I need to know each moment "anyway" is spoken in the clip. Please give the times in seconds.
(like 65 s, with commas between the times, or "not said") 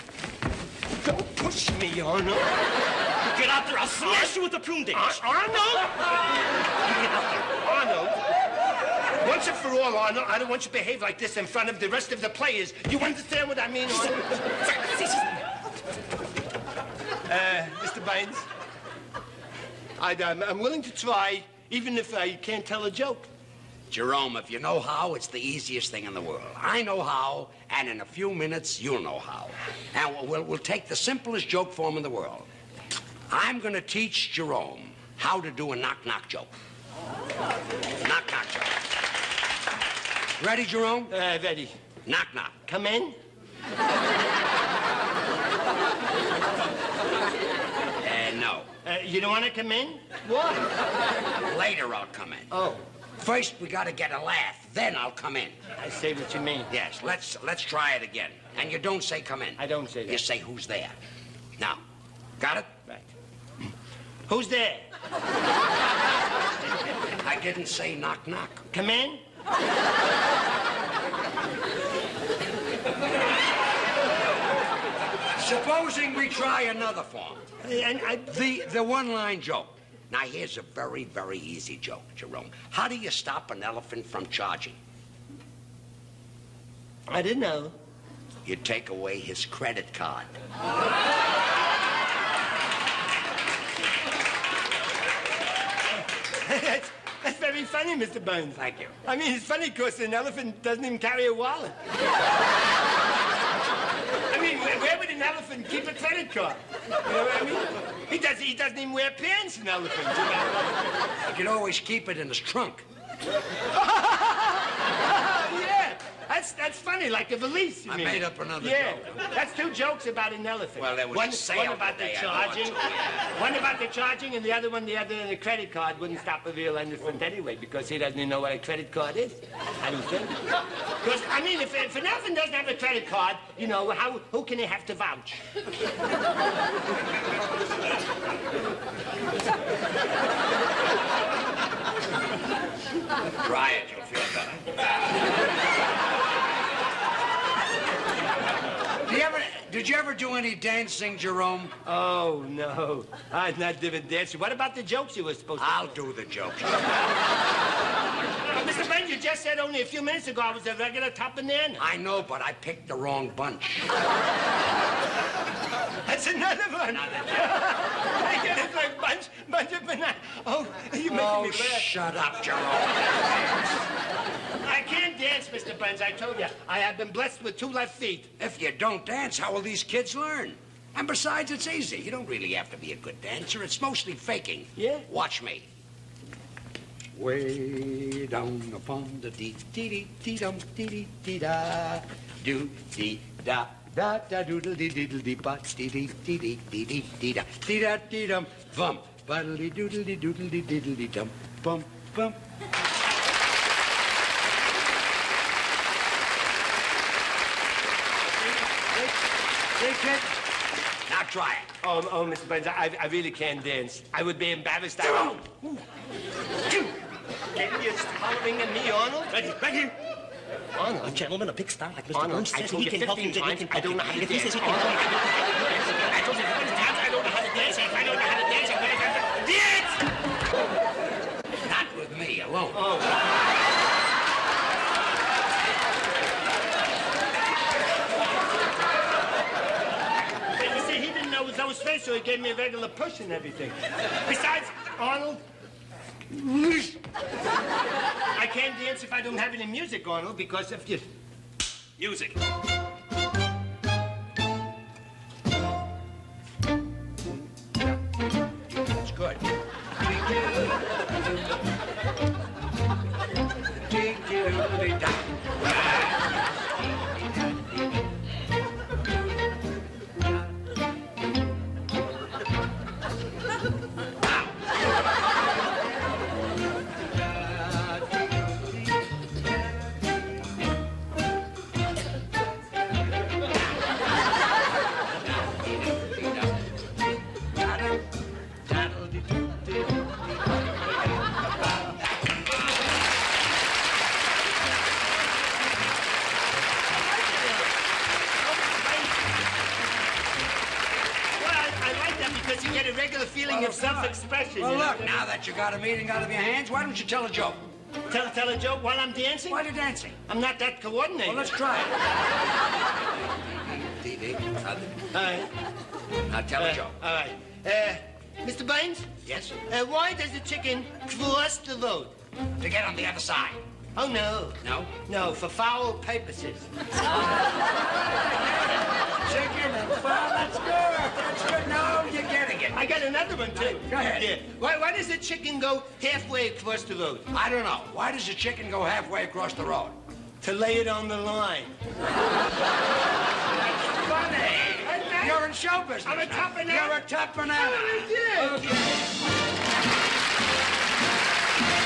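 127 s.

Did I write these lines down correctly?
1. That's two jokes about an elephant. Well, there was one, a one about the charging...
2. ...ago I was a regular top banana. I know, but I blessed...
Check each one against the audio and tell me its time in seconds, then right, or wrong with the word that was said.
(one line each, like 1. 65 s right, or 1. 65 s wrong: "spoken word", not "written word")
1. 119 s right
2. 160 s wrong: "picked", not "blessed".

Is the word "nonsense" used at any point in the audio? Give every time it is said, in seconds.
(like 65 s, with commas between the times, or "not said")
not said.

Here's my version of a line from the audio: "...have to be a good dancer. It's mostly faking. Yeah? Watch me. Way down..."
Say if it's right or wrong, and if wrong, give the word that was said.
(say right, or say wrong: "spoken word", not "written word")
right.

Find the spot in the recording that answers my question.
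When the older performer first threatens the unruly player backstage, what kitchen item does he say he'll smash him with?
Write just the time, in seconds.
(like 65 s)
4 s.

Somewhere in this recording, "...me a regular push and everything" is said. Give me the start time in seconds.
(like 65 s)
242 s.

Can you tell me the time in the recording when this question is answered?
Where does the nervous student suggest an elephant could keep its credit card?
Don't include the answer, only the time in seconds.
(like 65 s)
112 s.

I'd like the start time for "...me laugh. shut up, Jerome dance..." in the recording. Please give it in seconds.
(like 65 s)
171 s.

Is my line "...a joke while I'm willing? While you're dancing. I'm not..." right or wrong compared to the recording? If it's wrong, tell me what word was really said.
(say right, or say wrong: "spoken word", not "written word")
wrong: "dancing", not "willing".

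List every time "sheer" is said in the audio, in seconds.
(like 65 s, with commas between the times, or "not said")
not said.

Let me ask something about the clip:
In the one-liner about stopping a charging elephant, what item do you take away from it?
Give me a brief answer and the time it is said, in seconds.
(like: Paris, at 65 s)
his credit card, at 89 s.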